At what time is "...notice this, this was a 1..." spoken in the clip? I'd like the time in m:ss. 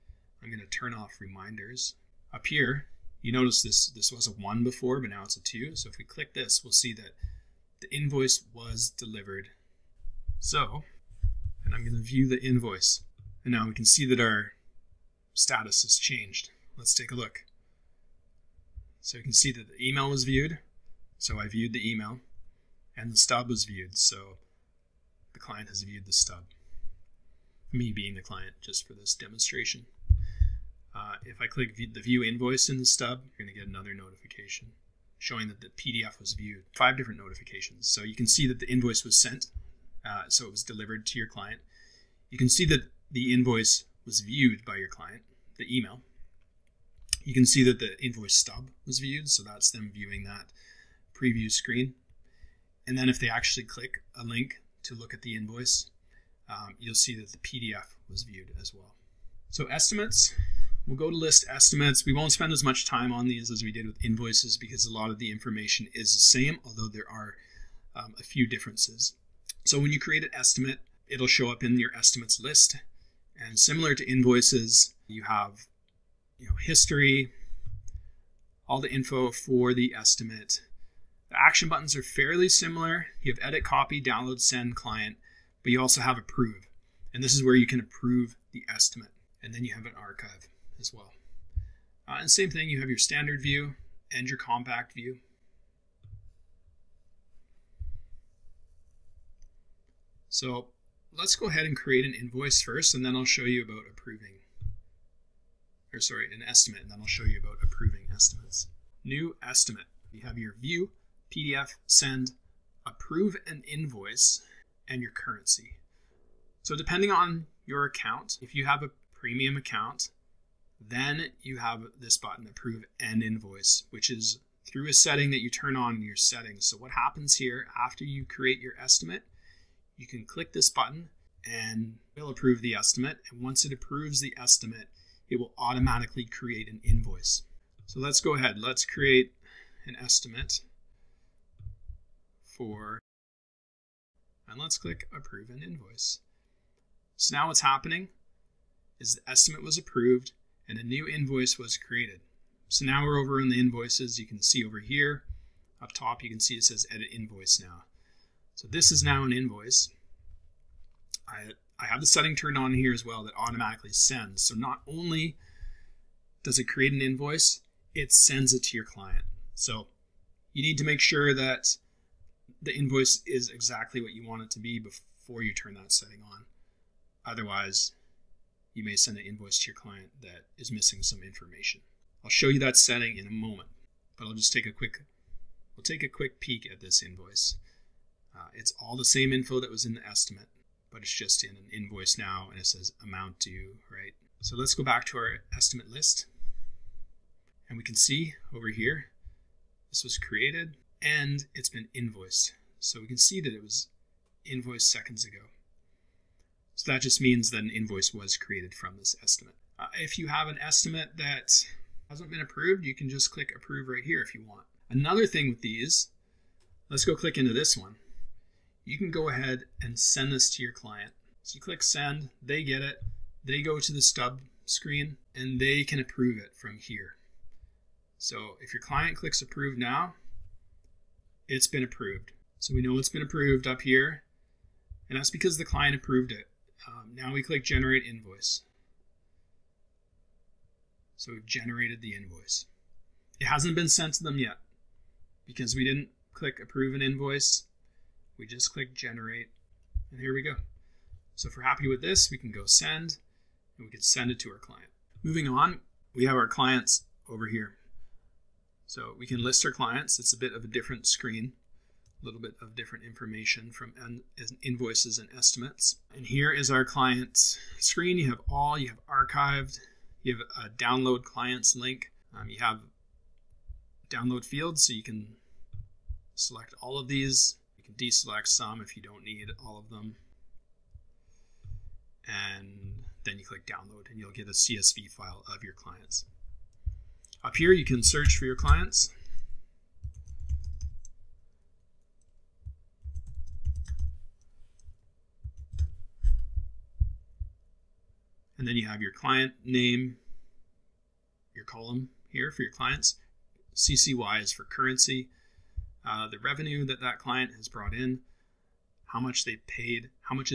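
0:03.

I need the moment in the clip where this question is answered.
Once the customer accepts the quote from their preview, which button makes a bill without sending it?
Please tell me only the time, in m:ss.
3:57.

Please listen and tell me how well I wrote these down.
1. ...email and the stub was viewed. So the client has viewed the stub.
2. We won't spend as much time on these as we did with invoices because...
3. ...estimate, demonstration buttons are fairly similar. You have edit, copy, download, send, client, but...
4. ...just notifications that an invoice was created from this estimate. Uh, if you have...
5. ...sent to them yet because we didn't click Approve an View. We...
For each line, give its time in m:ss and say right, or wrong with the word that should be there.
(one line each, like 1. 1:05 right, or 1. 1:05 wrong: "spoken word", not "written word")
1. 0:21 right
2. 1:02 right
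3. 1:19 wrong: "action", not "demonstration"
4. 3:27 wrong: "means", not "notifications"
5. 4:03 wrong: "Invoice", not "View".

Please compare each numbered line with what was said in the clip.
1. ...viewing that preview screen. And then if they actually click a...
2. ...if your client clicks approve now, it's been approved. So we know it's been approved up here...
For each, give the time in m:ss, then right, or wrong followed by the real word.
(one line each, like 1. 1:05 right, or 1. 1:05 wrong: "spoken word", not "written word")
1. 0:49 right
2. 3:48 right.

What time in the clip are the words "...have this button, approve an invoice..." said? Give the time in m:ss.
2:01.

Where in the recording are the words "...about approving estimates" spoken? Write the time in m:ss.
1:47.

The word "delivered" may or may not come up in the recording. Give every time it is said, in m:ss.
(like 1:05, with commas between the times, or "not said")
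0:08, 0:40.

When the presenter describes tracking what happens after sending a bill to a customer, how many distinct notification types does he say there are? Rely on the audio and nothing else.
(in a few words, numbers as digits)
5.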